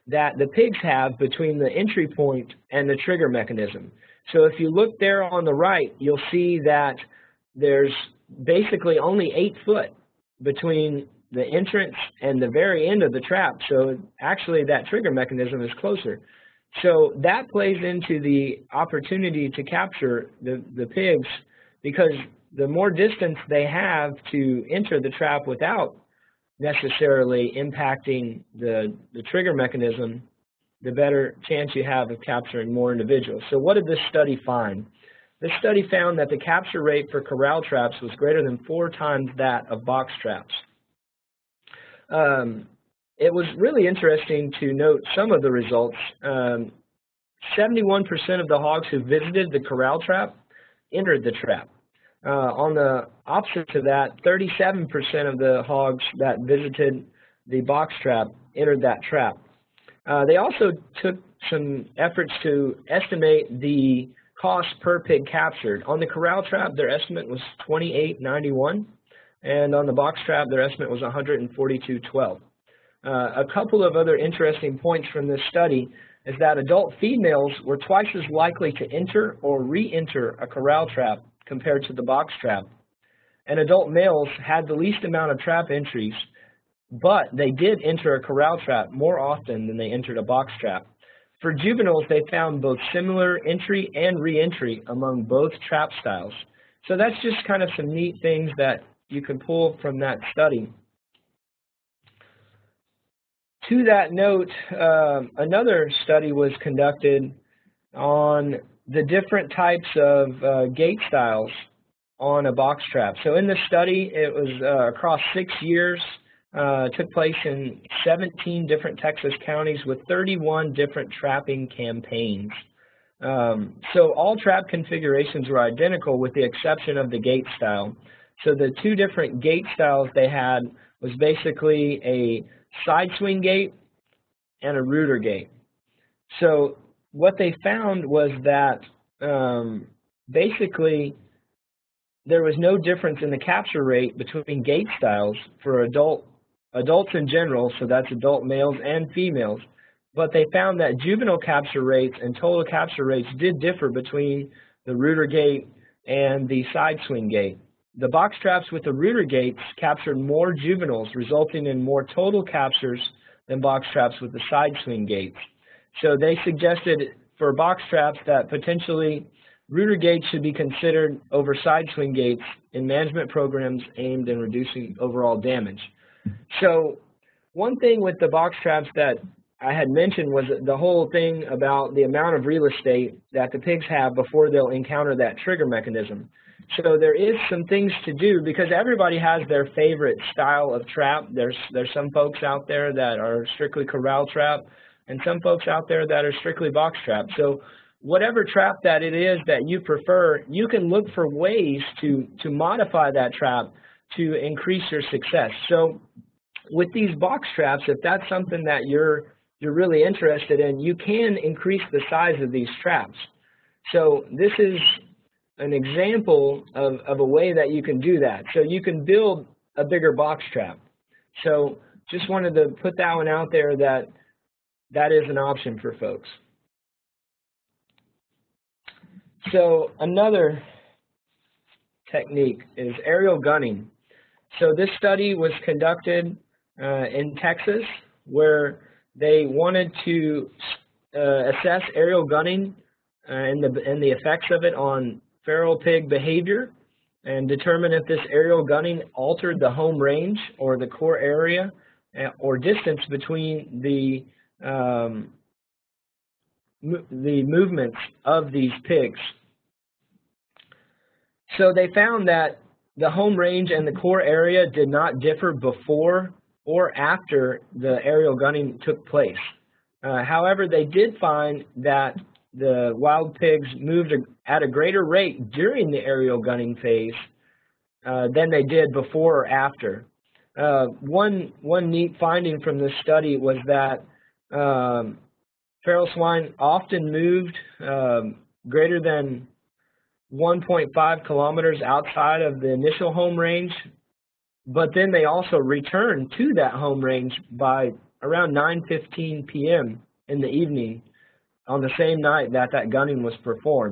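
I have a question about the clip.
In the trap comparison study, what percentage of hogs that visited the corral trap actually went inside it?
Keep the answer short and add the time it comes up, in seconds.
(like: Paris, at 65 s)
71%, at 46 s.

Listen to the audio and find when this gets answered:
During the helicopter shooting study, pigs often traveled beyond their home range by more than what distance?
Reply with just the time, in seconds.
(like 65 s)
290 s.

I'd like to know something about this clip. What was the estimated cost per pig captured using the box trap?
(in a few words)
$142.12.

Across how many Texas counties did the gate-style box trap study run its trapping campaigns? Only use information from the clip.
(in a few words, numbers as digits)
17.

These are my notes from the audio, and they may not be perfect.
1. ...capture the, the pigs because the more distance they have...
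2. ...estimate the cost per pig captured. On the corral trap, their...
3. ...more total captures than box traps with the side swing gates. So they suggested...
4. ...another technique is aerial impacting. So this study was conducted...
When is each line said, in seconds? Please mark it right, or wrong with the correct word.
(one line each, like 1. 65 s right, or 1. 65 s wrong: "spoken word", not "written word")
1. 19 s right
2. 62 s right
3. 161 s right
4. 230 s wrong: "gunning", not "impacting".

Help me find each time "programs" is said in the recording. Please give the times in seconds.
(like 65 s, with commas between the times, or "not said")
173 s.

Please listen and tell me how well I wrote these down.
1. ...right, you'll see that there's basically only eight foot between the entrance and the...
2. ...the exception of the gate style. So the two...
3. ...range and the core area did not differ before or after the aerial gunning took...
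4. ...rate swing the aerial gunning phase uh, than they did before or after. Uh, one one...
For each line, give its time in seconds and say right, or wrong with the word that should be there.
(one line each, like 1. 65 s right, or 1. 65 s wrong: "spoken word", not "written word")
1. 5 s right
2. 126 s right
3. 263 s right
4. 275 s wrong: "during", not "swing".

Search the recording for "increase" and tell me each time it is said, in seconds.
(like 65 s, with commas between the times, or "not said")
204 s, 211 s.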